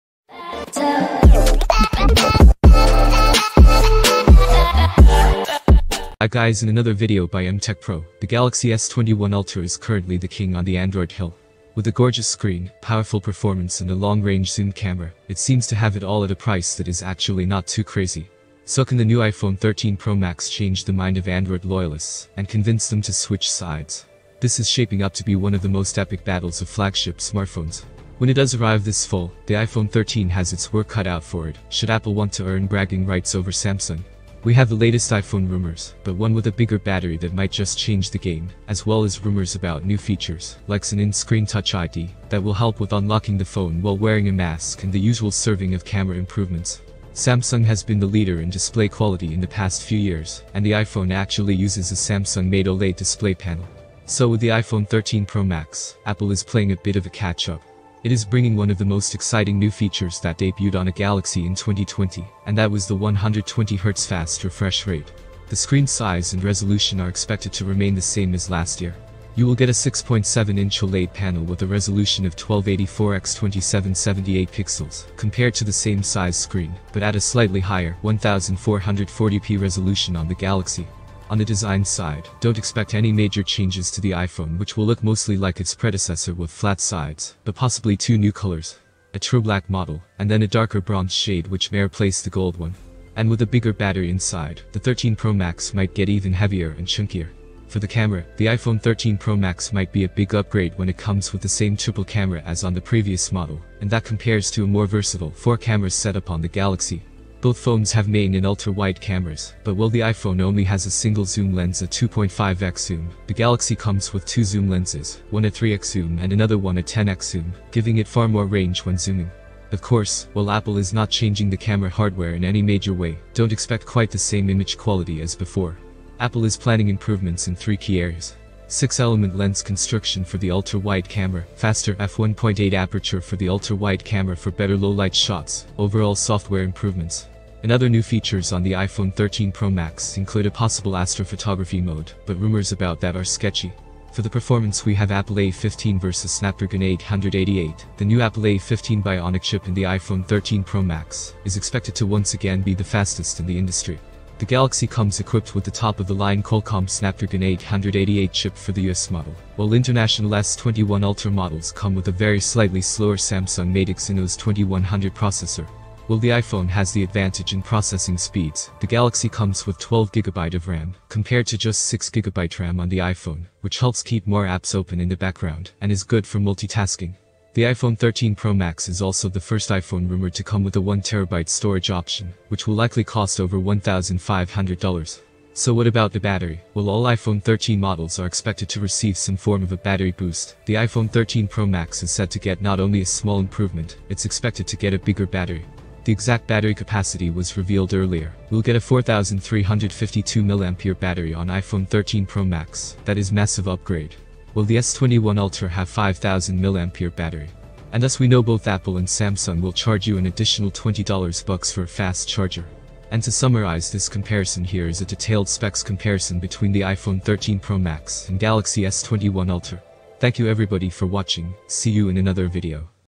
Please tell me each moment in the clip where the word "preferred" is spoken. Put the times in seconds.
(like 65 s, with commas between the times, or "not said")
not said.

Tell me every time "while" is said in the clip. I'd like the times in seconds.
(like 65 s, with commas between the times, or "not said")
43 s, 109 s, 120 s, 159 s, 166 s, 186 s.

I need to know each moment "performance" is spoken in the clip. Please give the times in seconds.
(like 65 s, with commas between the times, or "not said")
13 s, 144 s.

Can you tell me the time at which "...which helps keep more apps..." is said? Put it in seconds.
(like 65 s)
173 s.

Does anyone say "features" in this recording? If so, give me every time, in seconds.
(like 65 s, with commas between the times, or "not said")
39 s, 59 s, 138 s.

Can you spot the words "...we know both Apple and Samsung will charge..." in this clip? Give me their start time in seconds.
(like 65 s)
208 s.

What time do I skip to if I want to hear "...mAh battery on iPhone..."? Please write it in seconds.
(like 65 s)
200 s.